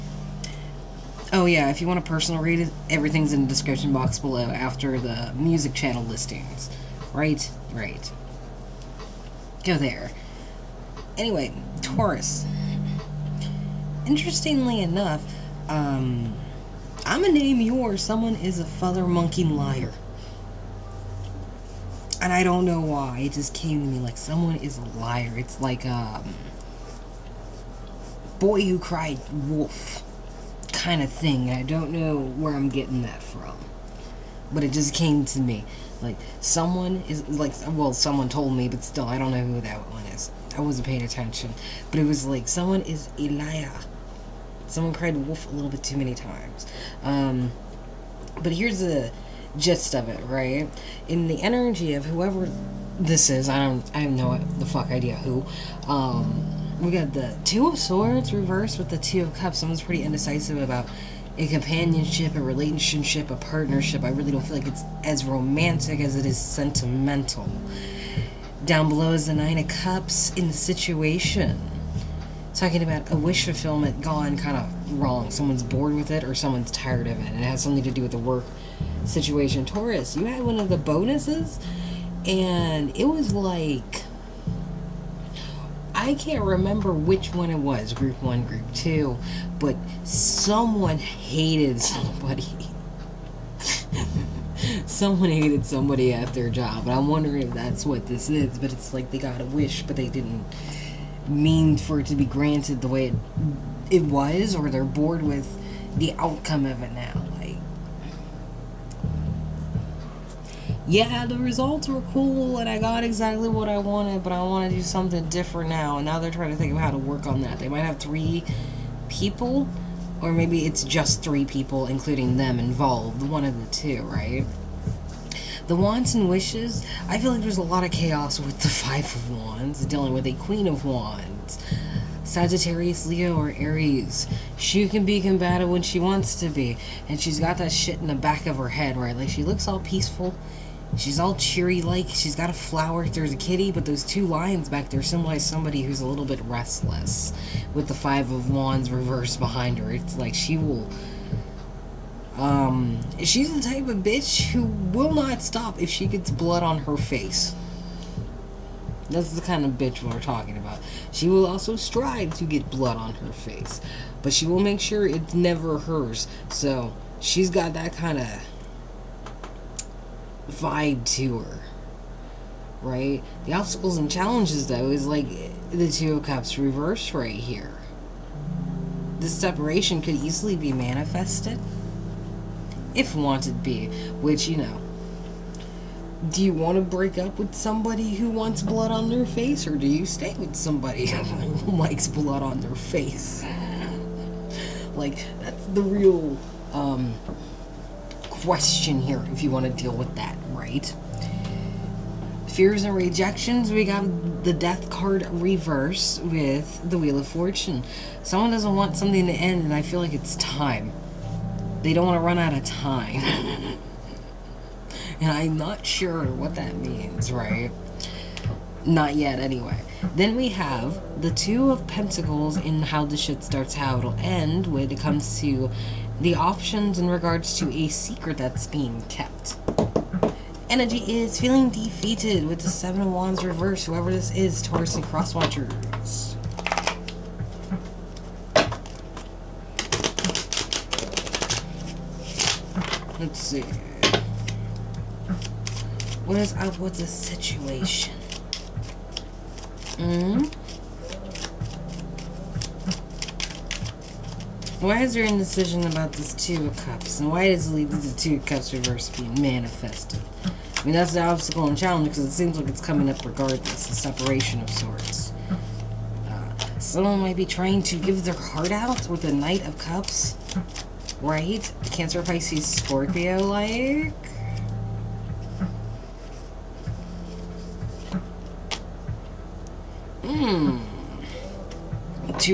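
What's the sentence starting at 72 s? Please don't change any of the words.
Talking about a wish fulfillment gone kind of wrong.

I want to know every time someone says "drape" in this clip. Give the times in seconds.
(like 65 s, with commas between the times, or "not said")
not said.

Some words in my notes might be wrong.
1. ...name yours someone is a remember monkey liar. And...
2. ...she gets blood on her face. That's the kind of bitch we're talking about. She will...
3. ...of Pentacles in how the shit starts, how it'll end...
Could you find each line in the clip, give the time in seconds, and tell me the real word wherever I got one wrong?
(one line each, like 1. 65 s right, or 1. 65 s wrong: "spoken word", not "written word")
1. 17 s wrong: "father", not "remember"
2. 155 s right
3. 221 s right.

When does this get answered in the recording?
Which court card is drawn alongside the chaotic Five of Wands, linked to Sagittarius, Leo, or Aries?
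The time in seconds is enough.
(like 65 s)
130 s.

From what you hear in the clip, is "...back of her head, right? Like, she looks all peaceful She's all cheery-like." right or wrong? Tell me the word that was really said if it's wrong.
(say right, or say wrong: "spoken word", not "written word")
right.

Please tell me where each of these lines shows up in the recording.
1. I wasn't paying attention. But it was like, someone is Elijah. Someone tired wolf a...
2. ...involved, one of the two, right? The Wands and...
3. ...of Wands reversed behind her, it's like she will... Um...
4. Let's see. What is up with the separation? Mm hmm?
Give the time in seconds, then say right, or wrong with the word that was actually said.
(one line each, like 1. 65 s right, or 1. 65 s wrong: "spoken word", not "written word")
1. 40 s wrong: "cried", not "tired"
2. 122 s right
3. 148 s right
4. 243 s wrong: "situation", not "separation".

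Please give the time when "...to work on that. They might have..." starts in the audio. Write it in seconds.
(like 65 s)
116 s.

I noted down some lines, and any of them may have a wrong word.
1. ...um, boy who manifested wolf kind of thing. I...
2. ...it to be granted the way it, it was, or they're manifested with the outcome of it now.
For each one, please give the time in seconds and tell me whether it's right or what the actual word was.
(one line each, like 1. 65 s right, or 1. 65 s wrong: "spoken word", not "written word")
1. 25 s wrong: "cried", not "manifested"
2. 102 s wrong: "bored", not "manifested".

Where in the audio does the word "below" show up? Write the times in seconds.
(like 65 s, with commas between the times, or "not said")
4 s, 68 s.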